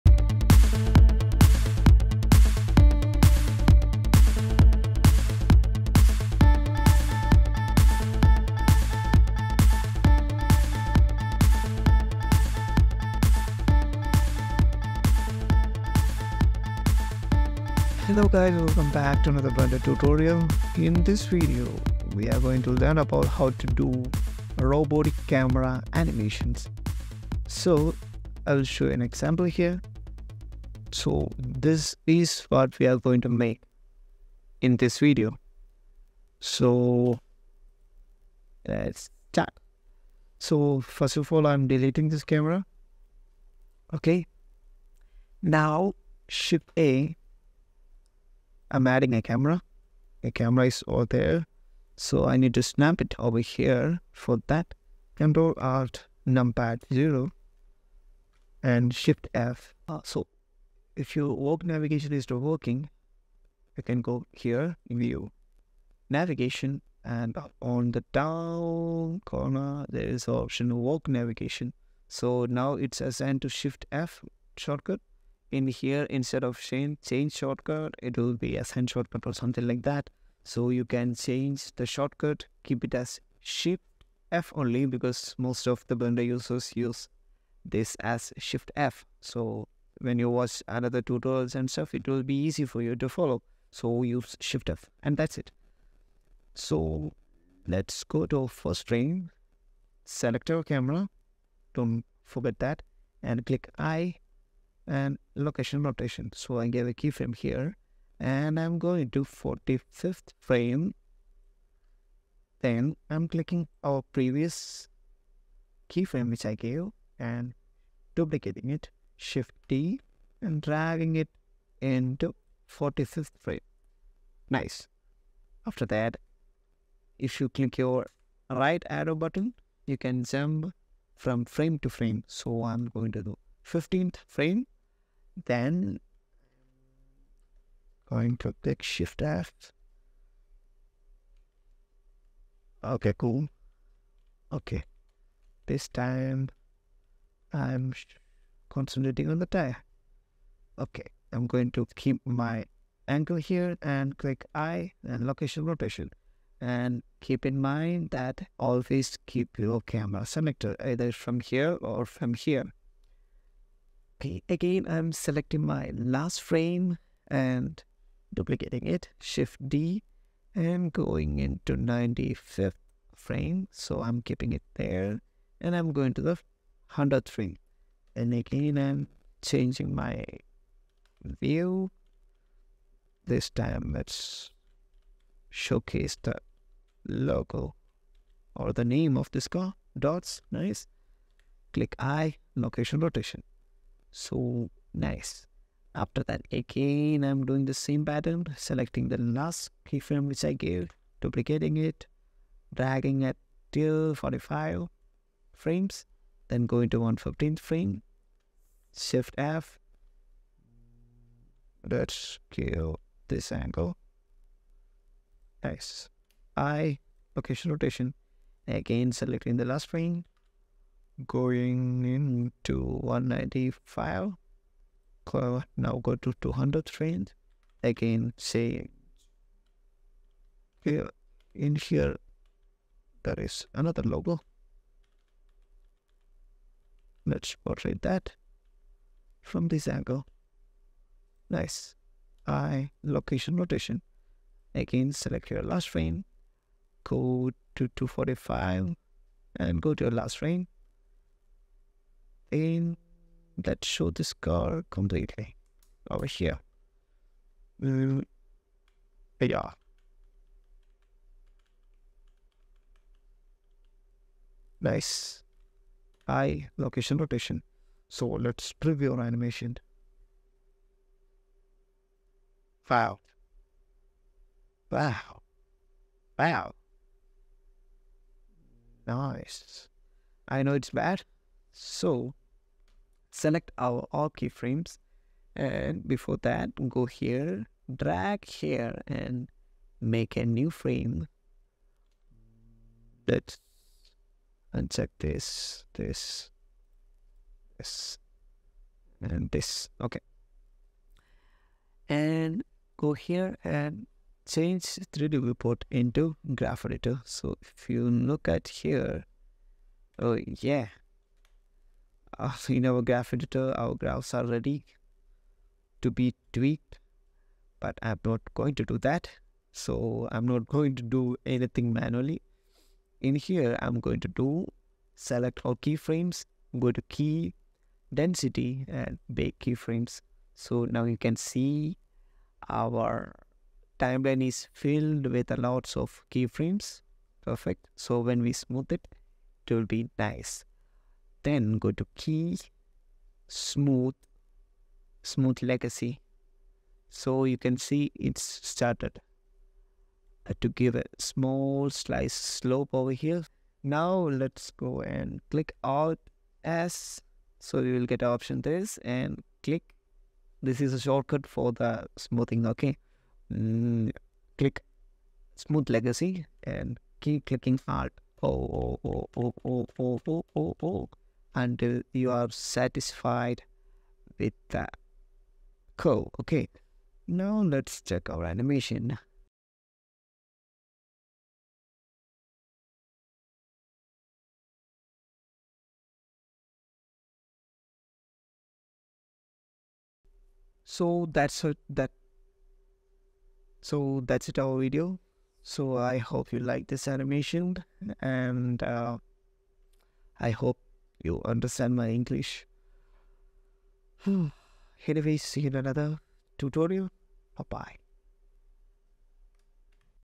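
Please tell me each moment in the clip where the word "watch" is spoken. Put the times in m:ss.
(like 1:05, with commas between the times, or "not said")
1:30.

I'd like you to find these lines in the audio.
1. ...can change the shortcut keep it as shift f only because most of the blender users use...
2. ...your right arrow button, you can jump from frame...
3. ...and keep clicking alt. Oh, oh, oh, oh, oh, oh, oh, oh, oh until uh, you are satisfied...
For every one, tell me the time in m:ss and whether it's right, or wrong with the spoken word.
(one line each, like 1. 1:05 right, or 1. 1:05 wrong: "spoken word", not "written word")
1. 1:20 right
2. 2:07 right
3. 6:06 right.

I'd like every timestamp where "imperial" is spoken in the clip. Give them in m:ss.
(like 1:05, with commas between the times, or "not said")
not said.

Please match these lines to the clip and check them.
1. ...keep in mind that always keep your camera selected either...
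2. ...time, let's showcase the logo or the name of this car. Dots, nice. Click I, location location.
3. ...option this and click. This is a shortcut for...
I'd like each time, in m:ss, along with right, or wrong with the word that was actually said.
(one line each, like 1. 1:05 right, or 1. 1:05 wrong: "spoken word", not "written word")
1. 2:37 right
2. 3:03 wrong: "rotation", not "location"
3. 5:58 right.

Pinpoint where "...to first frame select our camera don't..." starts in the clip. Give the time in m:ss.
1:38.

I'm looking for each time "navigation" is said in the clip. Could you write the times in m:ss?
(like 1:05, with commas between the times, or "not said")
1:01, 1:06, 1:11.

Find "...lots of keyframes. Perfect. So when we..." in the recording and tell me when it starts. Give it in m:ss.
5:35.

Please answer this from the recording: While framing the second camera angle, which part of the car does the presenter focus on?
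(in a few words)
The tire.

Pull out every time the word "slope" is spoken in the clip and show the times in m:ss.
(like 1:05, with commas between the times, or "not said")
5:52.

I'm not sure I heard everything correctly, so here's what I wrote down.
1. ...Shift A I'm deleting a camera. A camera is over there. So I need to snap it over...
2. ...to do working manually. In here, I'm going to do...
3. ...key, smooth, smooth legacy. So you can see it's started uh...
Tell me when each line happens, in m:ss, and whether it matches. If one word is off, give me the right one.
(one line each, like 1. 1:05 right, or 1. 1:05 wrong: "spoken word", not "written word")
1. 0:46 wrong: "adding", not "deleting"
2. 5:20 wrong: "anything", not "working"
3. 5:42 right.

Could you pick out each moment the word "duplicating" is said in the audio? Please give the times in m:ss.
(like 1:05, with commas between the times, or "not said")
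1:58, 2:48, 3:21.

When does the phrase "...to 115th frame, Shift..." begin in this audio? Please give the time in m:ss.
3:26.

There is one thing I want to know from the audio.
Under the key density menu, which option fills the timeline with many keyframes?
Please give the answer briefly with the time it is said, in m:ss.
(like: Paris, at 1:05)
Bake keyframes, at 5:29.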